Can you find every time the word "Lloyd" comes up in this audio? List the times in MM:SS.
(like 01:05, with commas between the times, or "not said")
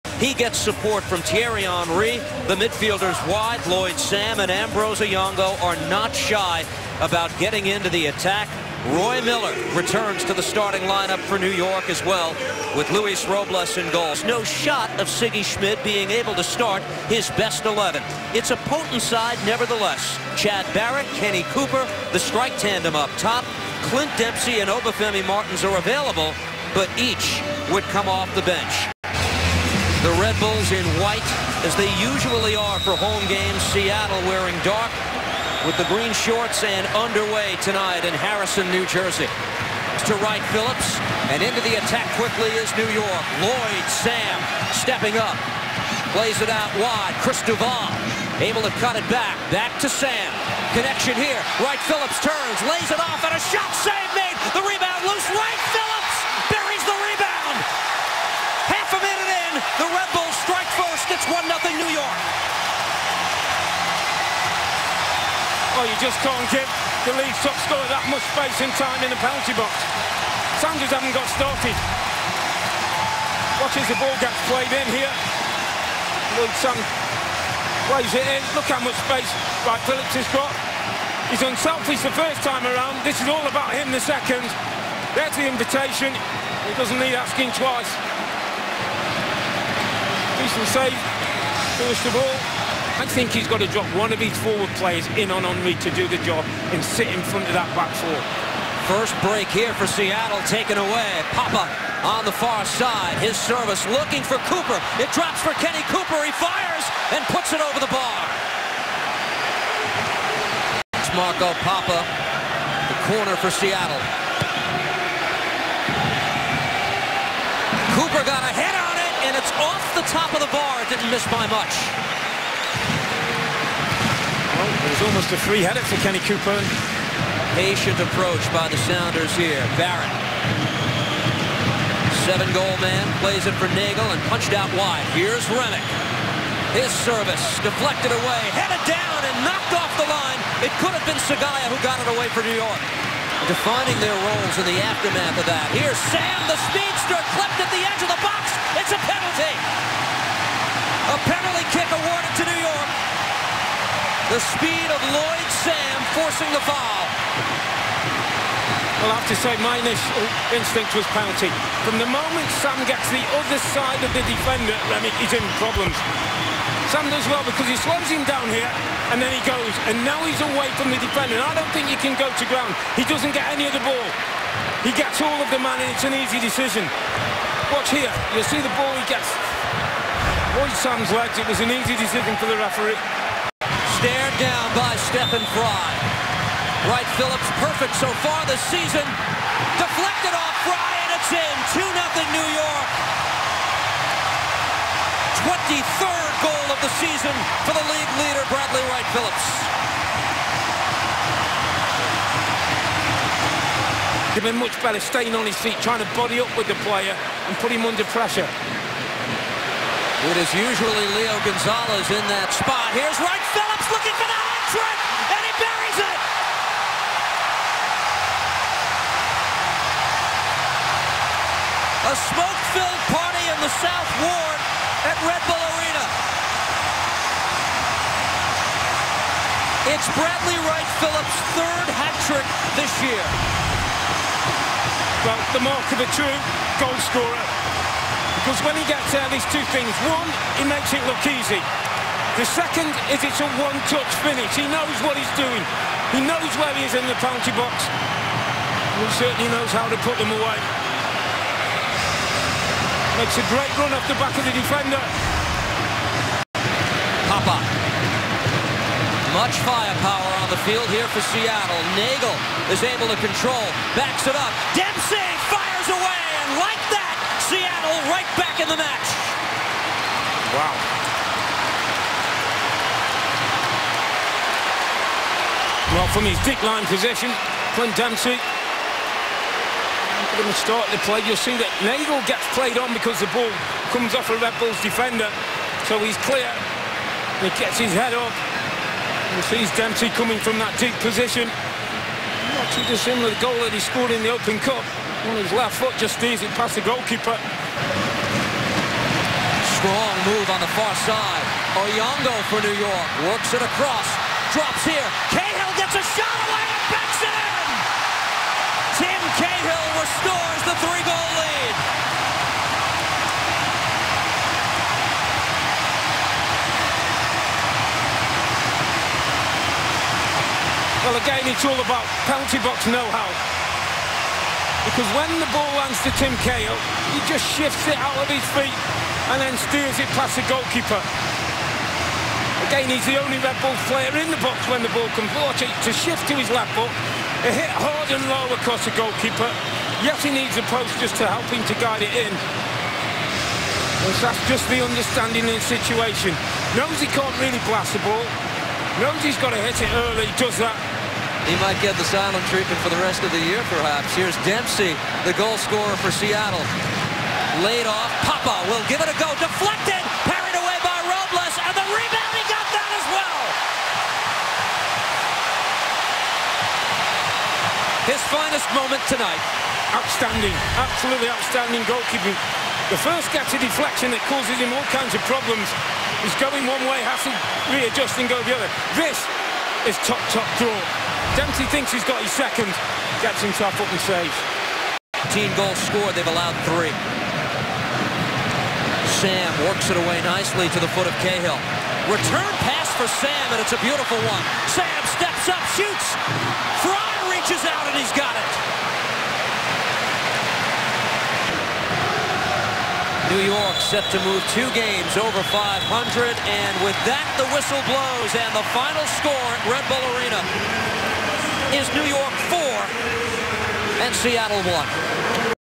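00:03, 00:43, 01:16, 02:35.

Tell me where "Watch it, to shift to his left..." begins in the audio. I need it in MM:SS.
05:35.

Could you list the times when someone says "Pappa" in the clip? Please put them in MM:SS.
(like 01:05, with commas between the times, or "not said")
01:41, 01:51, 04:17, 05:58.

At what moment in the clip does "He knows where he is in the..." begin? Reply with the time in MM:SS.
04:06.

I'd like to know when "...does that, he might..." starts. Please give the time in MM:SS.
05:50.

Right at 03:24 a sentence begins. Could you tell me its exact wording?
They've been much better staying on his feet, trying to body up with the player and put him under pressure.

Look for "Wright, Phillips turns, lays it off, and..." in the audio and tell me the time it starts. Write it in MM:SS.
00:51.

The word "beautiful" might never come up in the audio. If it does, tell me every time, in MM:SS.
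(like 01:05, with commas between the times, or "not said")
06:33.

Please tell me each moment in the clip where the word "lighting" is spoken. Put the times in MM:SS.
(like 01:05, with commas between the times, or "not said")
not said.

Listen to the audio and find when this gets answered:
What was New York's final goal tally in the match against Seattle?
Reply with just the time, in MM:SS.
06:52.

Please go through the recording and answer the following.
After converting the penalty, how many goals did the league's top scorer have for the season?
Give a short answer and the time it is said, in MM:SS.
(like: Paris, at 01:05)
23, at 03:15.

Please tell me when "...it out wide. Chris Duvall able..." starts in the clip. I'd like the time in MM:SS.
00:46.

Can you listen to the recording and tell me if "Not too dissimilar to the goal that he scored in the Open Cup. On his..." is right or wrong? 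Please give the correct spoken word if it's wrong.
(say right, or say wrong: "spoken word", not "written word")
right.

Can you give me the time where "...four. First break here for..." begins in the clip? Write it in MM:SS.
01:37.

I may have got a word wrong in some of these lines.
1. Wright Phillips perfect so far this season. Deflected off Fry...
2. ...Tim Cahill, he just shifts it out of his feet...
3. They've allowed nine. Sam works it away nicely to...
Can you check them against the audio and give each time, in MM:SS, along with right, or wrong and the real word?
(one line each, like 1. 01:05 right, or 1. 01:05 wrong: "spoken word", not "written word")
1. 03:06 right
2. 05:26 right
3. 06:26 wrong: "three", not "nine".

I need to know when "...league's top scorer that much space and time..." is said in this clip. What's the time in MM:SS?
01:07.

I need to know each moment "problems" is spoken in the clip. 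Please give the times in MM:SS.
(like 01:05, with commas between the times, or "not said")
02:45, 06:15.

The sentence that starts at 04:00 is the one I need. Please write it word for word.
One, he makes it look easy.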